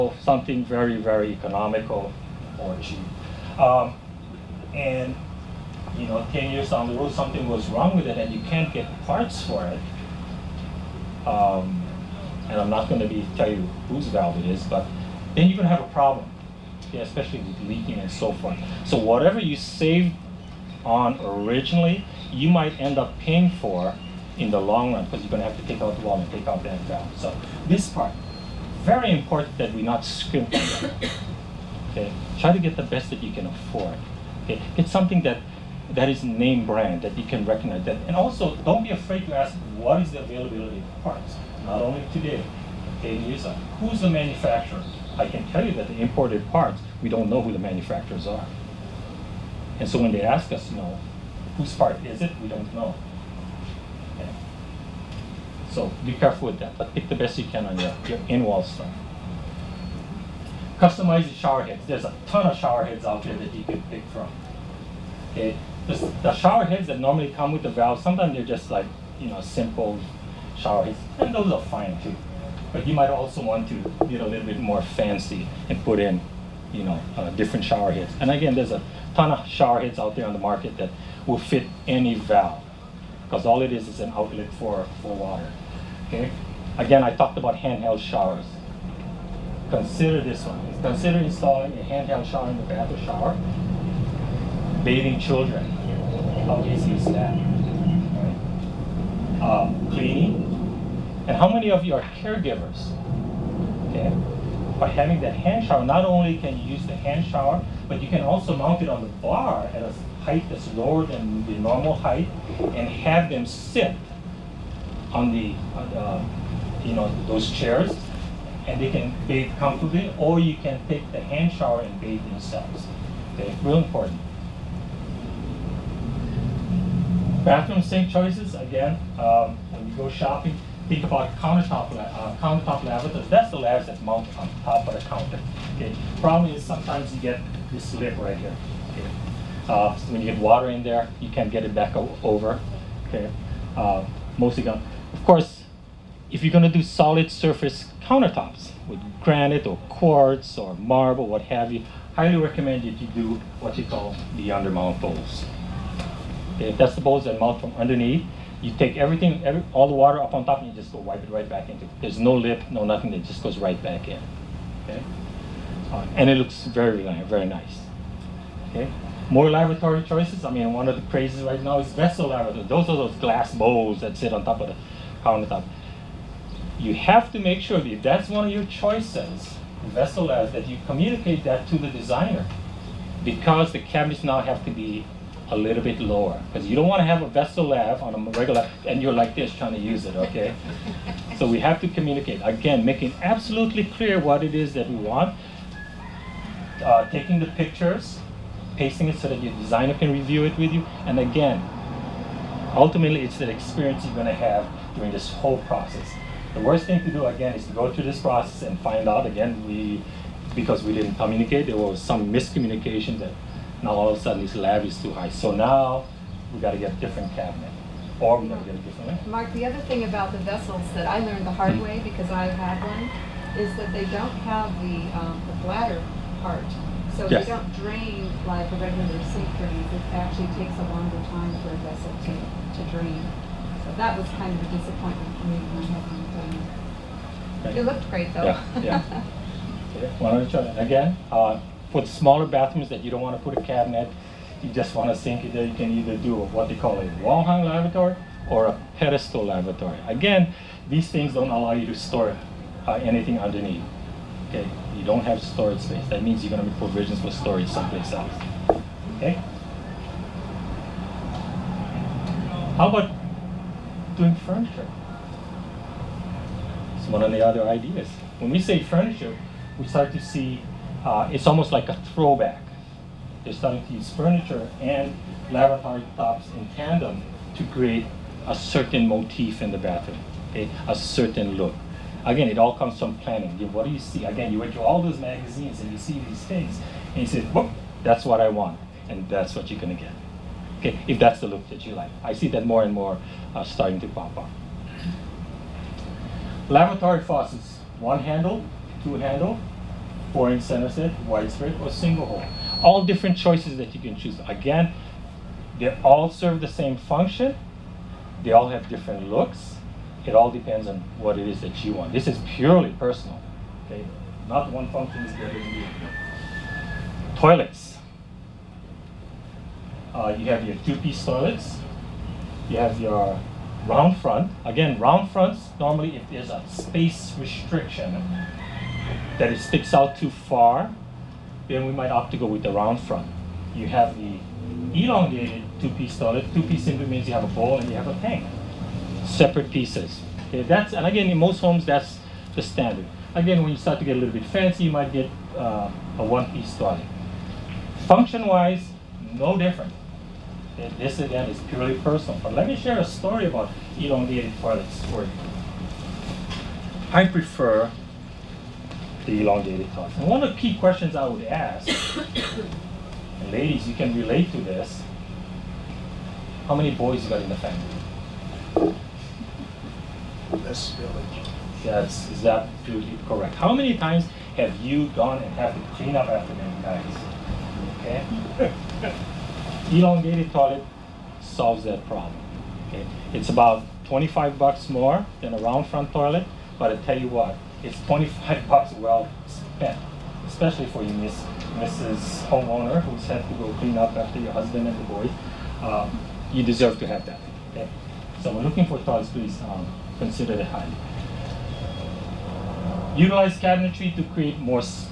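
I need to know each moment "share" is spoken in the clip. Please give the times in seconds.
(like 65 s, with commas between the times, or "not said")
352 s.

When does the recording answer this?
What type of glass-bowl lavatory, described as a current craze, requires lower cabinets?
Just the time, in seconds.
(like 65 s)
171 s.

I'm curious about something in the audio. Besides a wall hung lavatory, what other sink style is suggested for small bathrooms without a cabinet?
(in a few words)
pedestal lavatory.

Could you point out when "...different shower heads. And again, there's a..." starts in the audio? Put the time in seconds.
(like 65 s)
77 s.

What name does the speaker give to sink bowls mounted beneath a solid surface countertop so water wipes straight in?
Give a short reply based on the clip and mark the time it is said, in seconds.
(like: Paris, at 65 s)
undermount bowls, at 154 s.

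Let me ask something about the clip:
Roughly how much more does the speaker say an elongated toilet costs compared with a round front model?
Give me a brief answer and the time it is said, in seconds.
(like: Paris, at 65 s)
$25, at 384 s.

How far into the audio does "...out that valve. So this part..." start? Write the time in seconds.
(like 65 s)
26 s.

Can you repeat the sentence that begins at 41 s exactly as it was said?
Not only today, okay, in USA, who's the manufacturer?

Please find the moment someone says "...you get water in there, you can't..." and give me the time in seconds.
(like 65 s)
140 s.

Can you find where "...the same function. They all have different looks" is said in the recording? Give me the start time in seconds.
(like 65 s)
306 s.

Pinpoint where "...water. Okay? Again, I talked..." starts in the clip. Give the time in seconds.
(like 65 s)
85 s.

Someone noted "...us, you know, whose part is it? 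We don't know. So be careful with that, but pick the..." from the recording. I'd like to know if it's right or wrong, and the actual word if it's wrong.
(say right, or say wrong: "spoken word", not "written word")
right.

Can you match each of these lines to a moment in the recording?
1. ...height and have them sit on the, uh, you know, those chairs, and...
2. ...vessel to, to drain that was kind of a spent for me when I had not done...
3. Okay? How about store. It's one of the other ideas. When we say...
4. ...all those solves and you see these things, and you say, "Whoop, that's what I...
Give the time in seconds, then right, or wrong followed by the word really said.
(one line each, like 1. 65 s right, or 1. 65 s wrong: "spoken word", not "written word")
1. 111 s right
2. 231 s wrong: "disappointment", not "spent"
3. 259 s wrong: "furniture", not "store"
4. 284 s wrong: "magazines", not "solves".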